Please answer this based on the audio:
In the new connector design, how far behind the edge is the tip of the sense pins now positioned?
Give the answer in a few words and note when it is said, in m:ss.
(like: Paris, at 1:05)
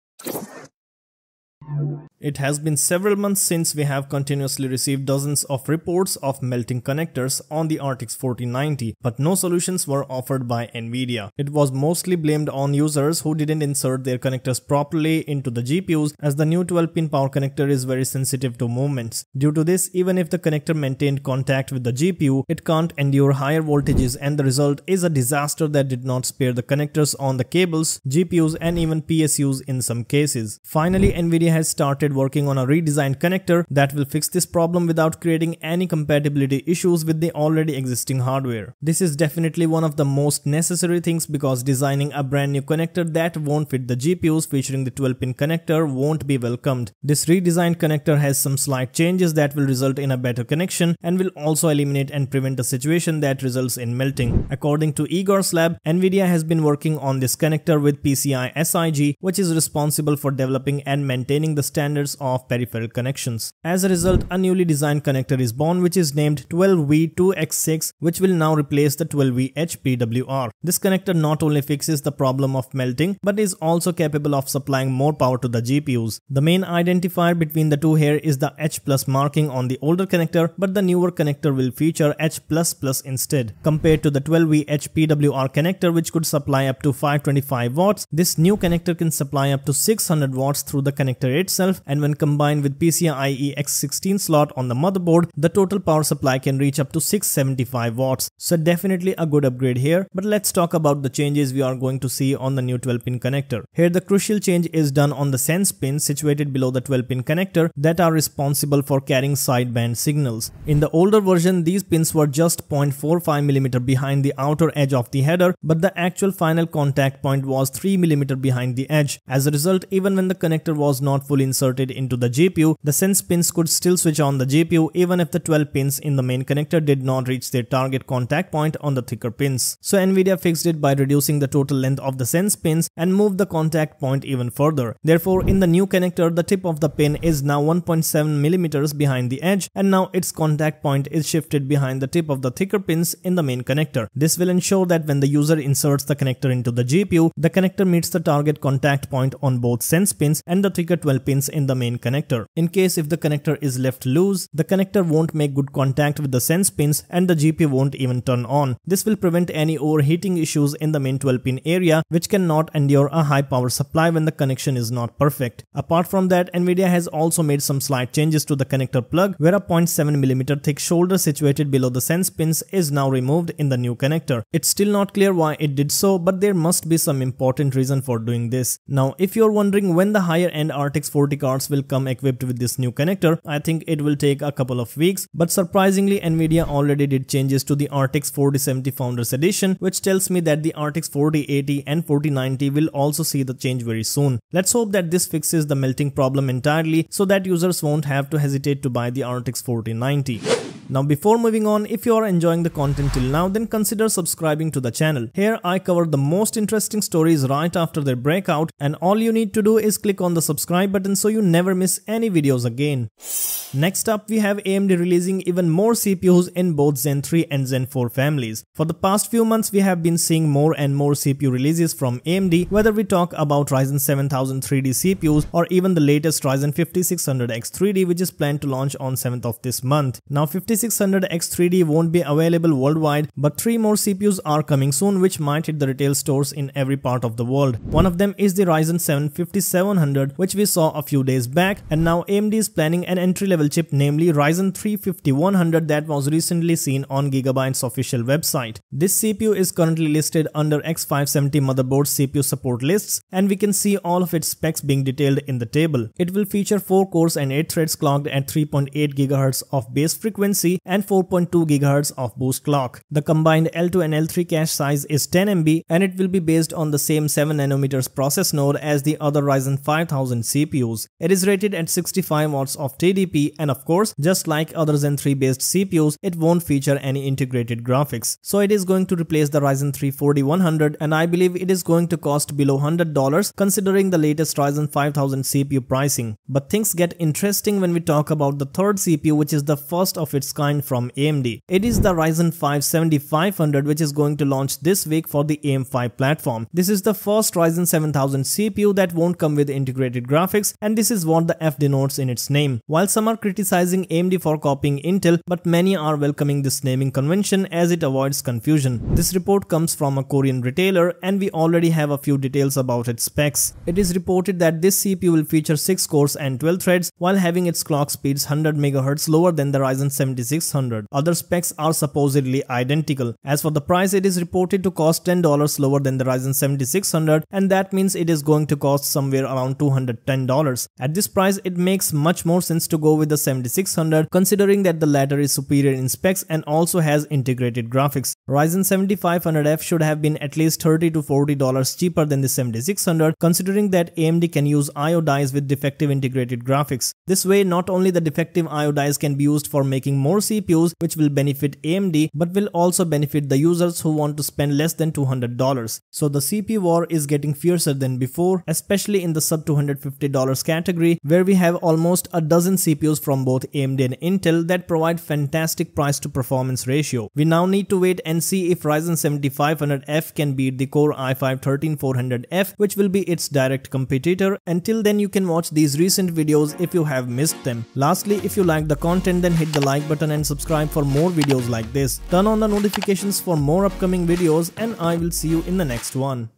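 1.7mm, at 2:17.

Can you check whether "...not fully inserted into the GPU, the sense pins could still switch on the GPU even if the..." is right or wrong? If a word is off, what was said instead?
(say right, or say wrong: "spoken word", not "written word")
right.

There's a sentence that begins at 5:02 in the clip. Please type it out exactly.
While some are criticizing AMD for copying Intel, but many are welcoming this naming convention as it avoids confusion.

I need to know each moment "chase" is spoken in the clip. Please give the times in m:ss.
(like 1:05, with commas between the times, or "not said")
not said.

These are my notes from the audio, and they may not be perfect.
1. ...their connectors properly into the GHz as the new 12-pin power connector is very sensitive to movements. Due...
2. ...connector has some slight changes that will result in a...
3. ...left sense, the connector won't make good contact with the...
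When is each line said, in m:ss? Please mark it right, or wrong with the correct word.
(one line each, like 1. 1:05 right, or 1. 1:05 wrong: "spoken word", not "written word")
1. 0:14 wrong: "GPUs", not "GHz"
2. 0:47 right
3. 2:33 wrong: "loose", not "sense".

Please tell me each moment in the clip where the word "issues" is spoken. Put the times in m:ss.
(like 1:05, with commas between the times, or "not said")
0:36, 2:40.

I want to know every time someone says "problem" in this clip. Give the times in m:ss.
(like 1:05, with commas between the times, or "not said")
0:34, 1:12, 3:16.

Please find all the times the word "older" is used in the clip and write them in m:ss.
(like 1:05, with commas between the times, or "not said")
1:19, 1:50.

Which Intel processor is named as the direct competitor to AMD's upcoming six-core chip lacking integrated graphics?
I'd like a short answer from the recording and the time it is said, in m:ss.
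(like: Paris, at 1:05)
Core i5-13400F, at 6:10.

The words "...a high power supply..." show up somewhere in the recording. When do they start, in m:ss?
2:43.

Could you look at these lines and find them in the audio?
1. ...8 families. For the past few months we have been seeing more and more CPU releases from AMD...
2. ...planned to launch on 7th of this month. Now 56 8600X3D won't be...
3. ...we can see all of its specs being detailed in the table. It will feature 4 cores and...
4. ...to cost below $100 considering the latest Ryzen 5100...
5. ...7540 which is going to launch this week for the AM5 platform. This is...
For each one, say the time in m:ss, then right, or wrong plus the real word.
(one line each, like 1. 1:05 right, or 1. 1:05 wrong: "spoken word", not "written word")
1. 3:37 wrong: "4", not "8"
2. 3:48 right
3. 4:13 right
4. 4:42 wrong: "5000", not "5100"
5. 4:52 wrong: "7500", not "7540".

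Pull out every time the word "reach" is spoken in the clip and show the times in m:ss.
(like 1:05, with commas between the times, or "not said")
1:36, 2:07.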